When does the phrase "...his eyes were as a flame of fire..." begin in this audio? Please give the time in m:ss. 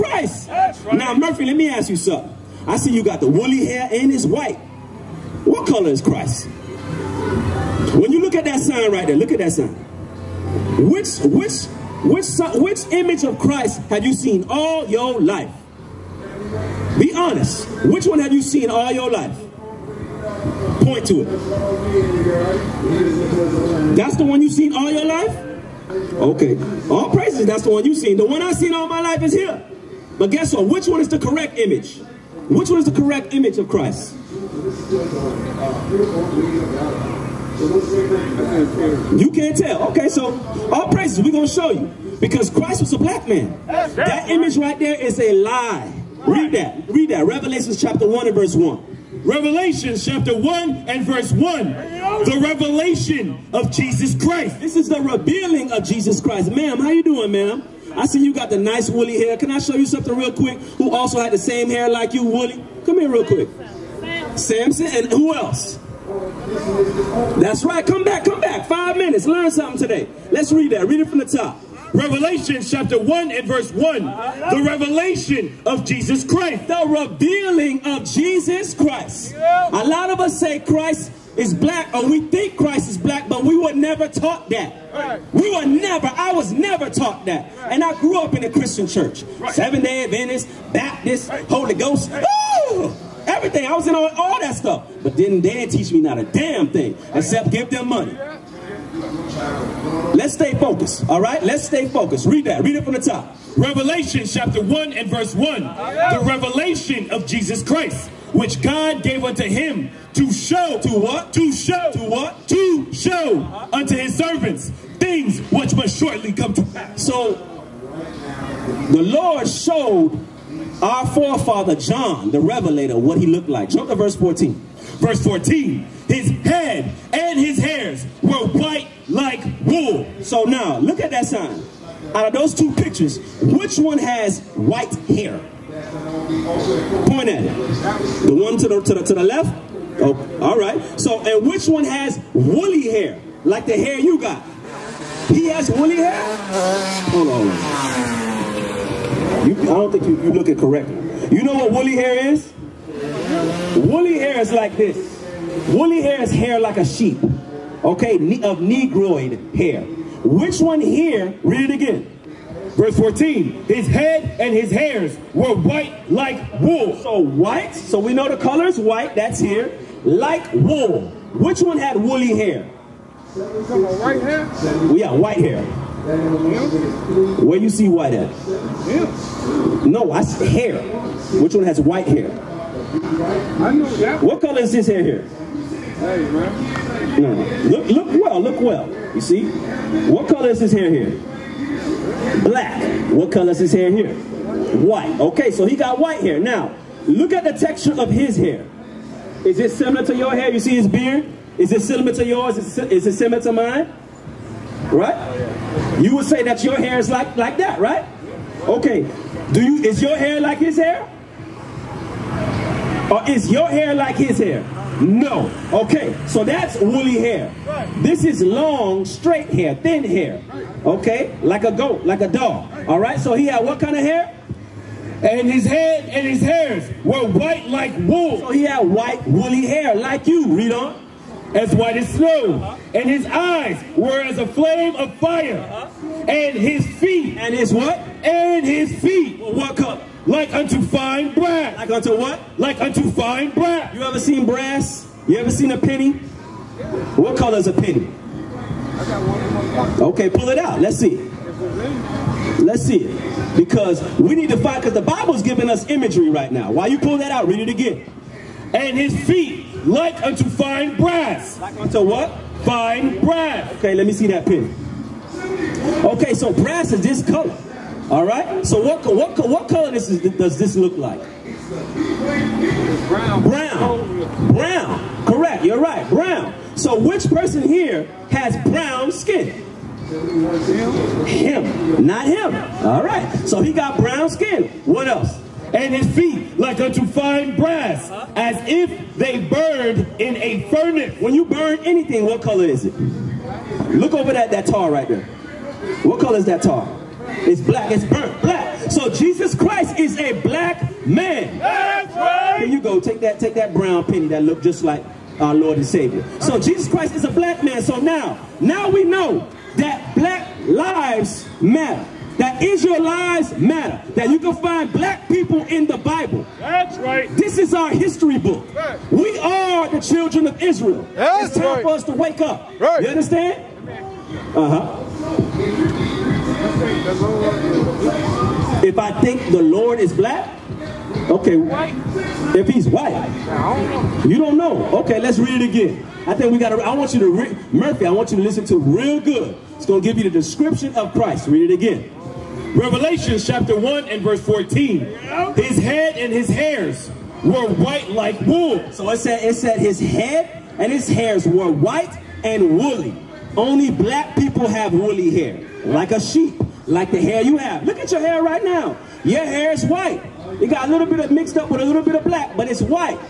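3:53.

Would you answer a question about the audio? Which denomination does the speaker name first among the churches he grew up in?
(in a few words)
Seventh-day Adventist.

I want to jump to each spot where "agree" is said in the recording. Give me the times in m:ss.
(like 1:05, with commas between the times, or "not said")
not said.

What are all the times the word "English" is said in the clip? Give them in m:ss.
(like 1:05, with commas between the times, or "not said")
not said.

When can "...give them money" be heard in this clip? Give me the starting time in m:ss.
1:37.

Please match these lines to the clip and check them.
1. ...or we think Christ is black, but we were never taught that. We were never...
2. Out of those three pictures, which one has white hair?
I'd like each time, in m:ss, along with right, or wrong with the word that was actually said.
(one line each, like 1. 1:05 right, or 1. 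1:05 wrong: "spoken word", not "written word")
1. 1:21 right
2. 2:12 wrong: "two", not "three".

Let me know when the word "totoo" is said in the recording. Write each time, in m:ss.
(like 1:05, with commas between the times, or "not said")
not said.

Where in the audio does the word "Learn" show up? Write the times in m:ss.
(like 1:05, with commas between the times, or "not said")
1:09.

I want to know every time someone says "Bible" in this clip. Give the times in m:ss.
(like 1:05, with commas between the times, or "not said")
4:15, 5:15.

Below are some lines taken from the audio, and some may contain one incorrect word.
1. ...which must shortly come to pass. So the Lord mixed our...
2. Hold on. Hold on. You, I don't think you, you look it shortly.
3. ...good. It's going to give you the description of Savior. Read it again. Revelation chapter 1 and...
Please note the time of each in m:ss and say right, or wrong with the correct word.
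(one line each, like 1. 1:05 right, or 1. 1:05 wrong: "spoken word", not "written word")
1. 1:55 wrong: "showed", not "mixed"
2. 2:26 wrong: "correctly", not "shortly"
3. 5:39 wrong: "Christ", not "Savior".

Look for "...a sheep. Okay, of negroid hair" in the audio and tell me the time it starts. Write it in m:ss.
2:36.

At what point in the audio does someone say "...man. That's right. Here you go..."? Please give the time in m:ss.
5:01.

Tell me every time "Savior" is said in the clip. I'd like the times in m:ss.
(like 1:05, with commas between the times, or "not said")
5:05.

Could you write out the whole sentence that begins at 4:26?
Okay, so brass is this color.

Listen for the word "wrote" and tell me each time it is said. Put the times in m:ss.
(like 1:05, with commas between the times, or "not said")
not said.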